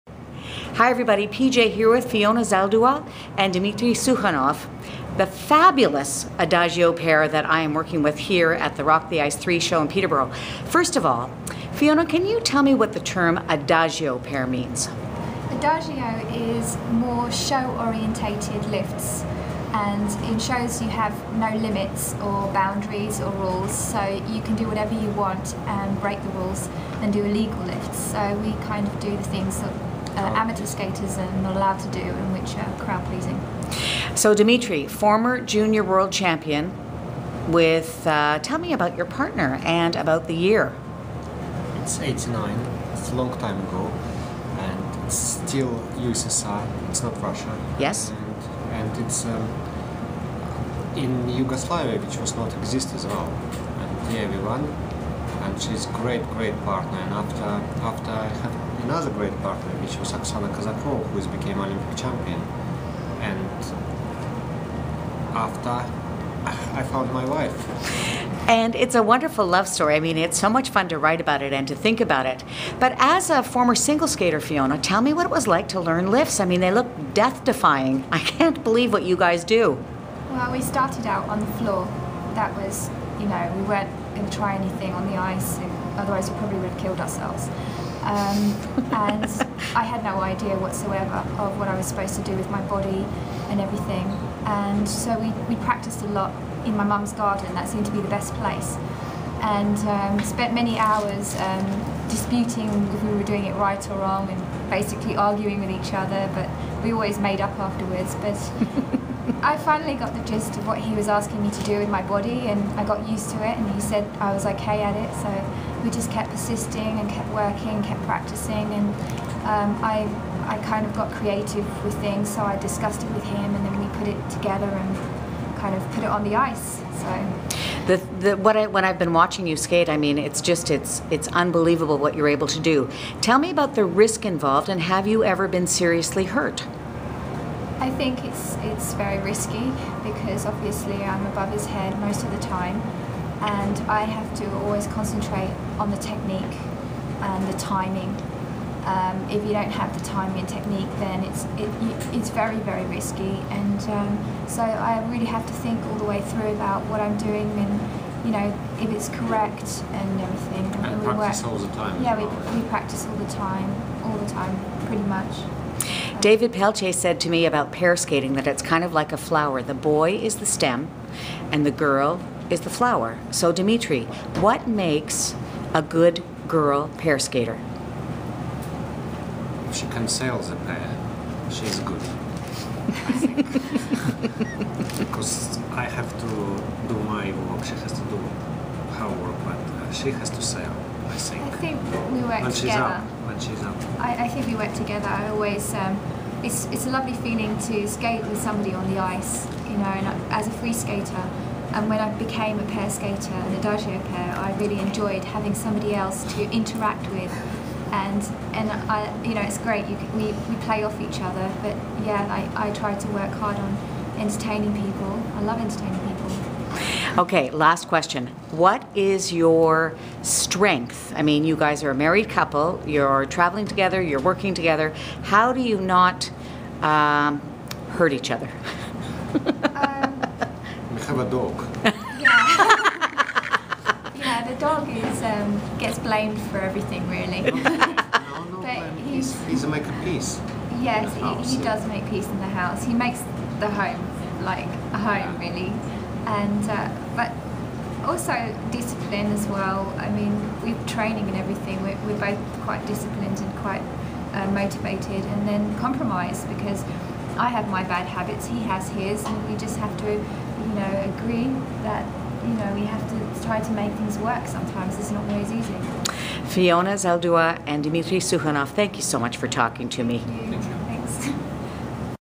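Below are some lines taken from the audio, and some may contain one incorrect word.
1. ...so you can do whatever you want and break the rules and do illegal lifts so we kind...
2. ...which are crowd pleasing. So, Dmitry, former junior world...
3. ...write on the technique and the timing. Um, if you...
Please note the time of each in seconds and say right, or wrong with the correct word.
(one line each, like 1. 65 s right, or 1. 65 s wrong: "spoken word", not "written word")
1. 23 s right
2. 32 s wrong: "Dimitri", not "Dmitry"
3. 144 s wrong: "concentrate", not "write".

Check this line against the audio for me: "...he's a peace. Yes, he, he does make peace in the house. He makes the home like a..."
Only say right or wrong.
right.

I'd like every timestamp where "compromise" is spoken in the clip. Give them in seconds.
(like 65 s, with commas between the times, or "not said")
255 s.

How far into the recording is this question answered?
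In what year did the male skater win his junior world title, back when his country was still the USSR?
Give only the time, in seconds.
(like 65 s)
41 s.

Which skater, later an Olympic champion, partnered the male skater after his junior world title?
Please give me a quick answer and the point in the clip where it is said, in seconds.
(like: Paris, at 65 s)
Oksana Kazakova, at 60 s.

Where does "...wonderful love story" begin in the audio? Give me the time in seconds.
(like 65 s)
69 s.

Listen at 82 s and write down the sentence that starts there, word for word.
That was, you know, we weren't going to try anything on the ice, otherwise, we probably would have killed ourselves.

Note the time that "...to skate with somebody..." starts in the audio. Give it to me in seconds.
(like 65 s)
197 s.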